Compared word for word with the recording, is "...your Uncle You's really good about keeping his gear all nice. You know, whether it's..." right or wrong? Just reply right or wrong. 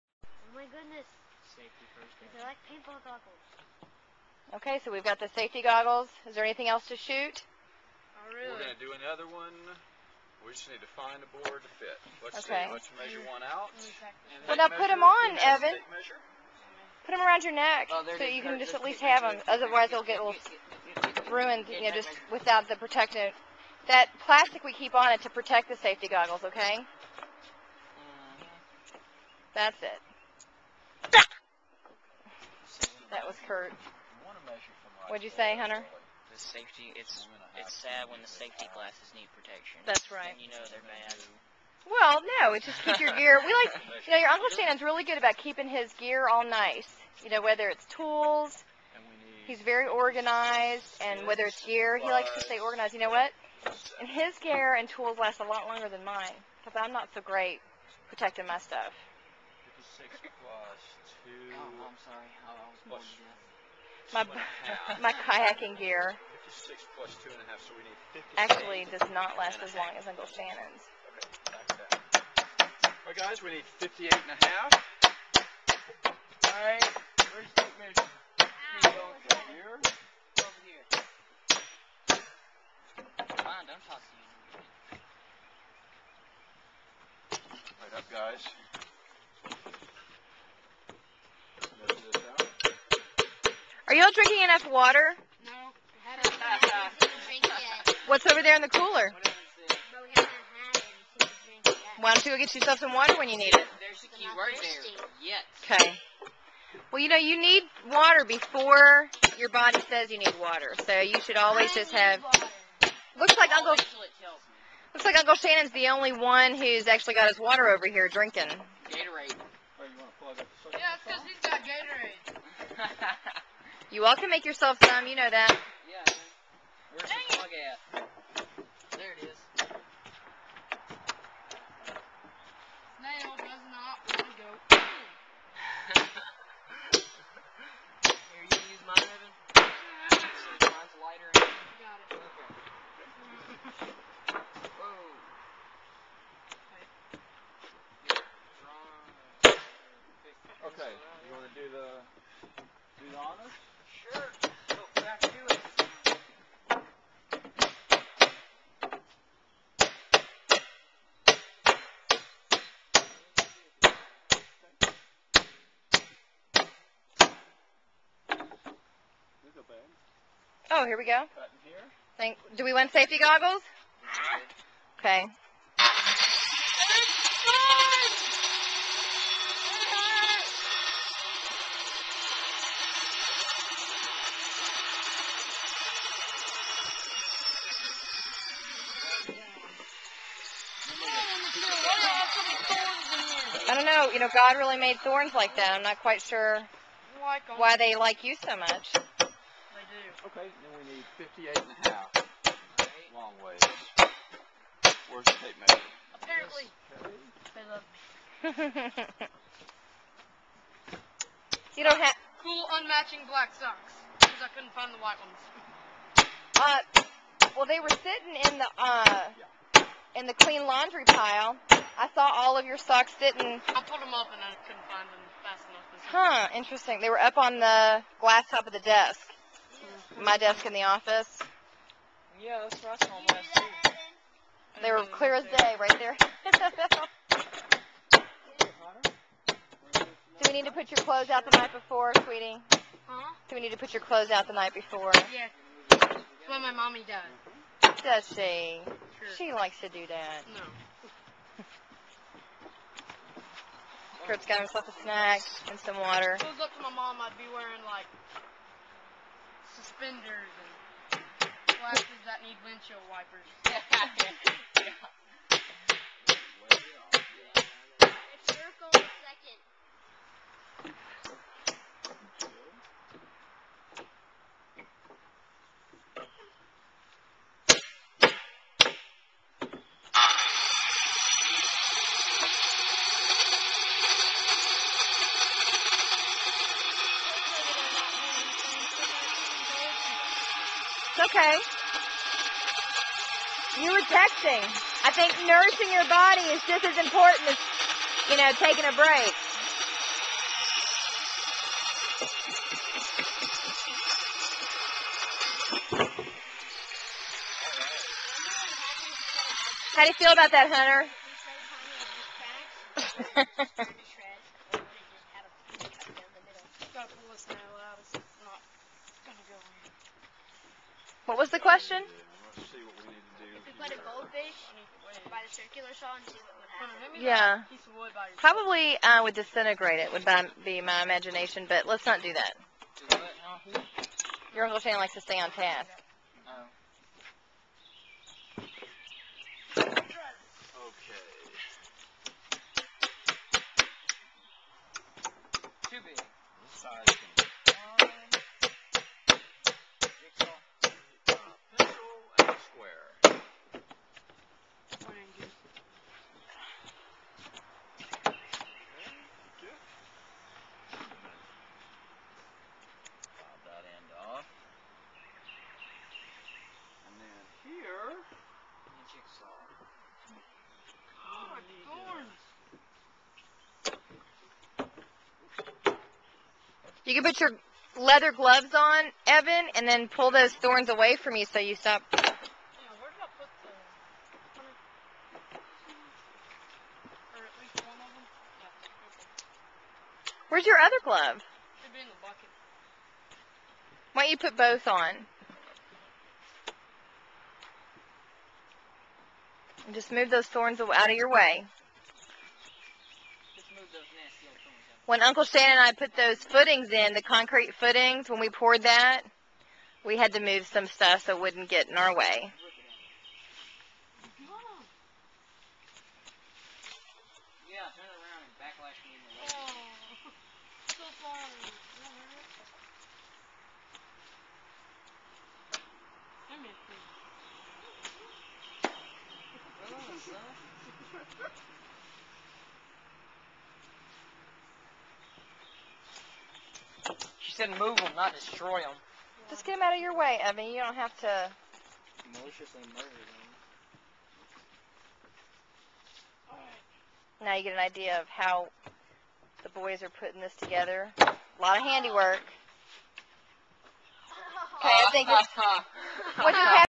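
wrong.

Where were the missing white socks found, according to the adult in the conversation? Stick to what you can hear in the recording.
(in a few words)
glass top of the desk.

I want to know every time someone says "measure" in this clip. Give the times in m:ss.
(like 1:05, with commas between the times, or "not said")
0:12, 1:17, 3:25.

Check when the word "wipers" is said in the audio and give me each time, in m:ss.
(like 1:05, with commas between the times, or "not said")
4:23.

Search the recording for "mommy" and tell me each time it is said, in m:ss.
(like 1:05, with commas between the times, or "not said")
4:06.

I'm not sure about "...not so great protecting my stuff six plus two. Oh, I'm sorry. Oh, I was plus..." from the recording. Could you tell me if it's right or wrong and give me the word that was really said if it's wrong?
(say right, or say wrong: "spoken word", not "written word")
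right.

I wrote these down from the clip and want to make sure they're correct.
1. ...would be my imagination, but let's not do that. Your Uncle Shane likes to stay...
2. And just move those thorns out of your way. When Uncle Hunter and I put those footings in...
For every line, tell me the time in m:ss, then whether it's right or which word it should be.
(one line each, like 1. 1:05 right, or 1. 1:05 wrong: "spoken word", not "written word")
1. 5:30 right
2. 6:39 wrong: "Shannon", not "Hunter".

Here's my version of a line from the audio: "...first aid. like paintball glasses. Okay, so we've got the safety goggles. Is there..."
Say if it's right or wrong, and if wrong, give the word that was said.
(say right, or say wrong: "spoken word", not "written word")
wrong: "goggles", not "glasses".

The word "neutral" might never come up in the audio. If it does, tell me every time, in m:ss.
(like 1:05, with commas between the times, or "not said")
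not said.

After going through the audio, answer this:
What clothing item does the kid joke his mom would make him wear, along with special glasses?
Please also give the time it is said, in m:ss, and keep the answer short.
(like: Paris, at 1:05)
suspenders, at 4:19.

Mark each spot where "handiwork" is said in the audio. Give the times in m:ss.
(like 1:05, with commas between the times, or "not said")
7:31.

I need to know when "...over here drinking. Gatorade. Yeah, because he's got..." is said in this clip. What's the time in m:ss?
1:57.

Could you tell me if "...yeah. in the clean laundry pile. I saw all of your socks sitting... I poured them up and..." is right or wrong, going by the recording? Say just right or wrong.
wrong.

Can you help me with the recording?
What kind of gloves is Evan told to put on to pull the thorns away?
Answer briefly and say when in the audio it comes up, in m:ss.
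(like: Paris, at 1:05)
leather gloves, at 6:17.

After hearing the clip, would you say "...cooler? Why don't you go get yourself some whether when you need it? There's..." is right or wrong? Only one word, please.
wrong.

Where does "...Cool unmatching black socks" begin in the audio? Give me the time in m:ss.
3:32.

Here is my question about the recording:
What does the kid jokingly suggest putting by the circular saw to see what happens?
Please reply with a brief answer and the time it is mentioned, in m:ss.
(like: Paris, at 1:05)
a goldfish, at 5:23.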